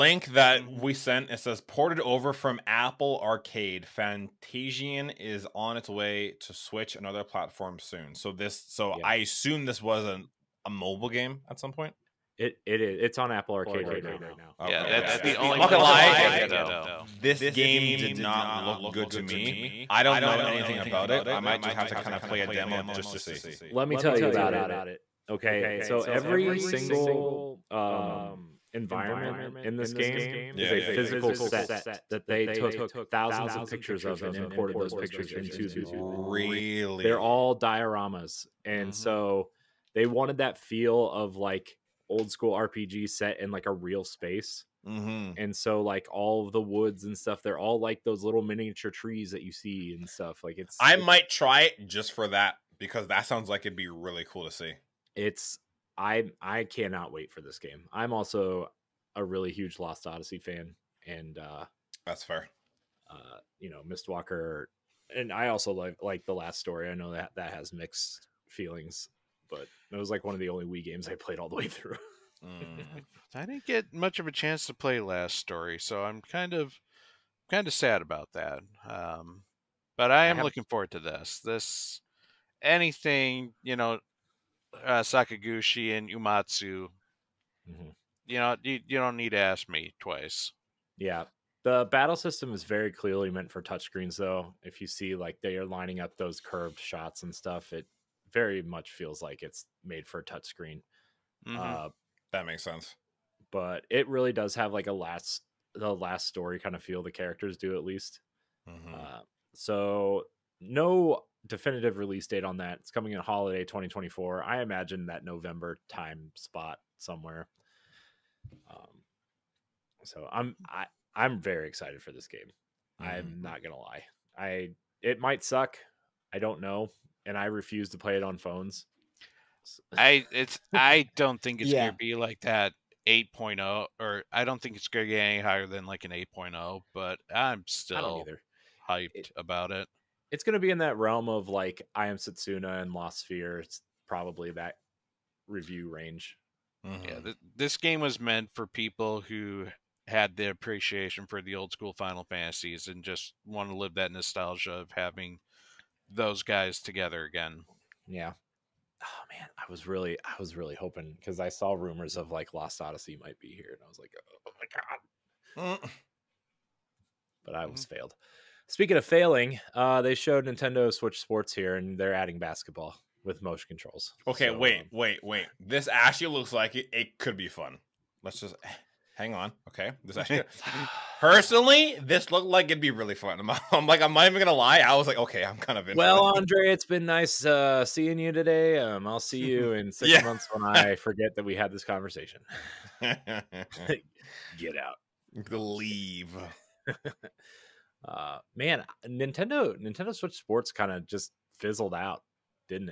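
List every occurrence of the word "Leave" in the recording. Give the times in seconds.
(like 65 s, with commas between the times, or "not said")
195 s.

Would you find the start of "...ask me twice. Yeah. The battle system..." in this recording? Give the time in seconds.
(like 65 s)
89 s.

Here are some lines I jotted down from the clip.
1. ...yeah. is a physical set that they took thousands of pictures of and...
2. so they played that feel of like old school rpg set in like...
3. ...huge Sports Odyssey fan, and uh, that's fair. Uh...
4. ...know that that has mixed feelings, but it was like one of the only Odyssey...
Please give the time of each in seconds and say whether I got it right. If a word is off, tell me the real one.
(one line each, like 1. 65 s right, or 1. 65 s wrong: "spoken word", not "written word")
1. 30 s right
2. 38 s wrong: "wanted", not "played"
3. 59 s wrong: "Lost", not "Sports"
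4. 66 s wrong: "Wii", not "Odyssey".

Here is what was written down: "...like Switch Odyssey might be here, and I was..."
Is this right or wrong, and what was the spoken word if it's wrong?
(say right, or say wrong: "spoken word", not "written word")
wrong: "Lost", not "Switch".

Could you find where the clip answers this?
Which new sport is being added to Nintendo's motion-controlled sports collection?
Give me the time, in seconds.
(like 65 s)
172 s.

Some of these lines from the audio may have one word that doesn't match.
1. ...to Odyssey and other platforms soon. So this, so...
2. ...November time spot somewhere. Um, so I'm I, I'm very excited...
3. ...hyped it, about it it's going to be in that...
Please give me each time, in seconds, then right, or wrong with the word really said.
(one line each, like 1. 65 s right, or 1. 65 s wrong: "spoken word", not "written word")
1. 6 s wrong: "Switch", not "Odyssey"
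2. 115 s right
3. 138 s right.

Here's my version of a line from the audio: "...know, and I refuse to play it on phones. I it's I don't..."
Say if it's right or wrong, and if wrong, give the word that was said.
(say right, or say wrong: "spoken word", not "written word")
right.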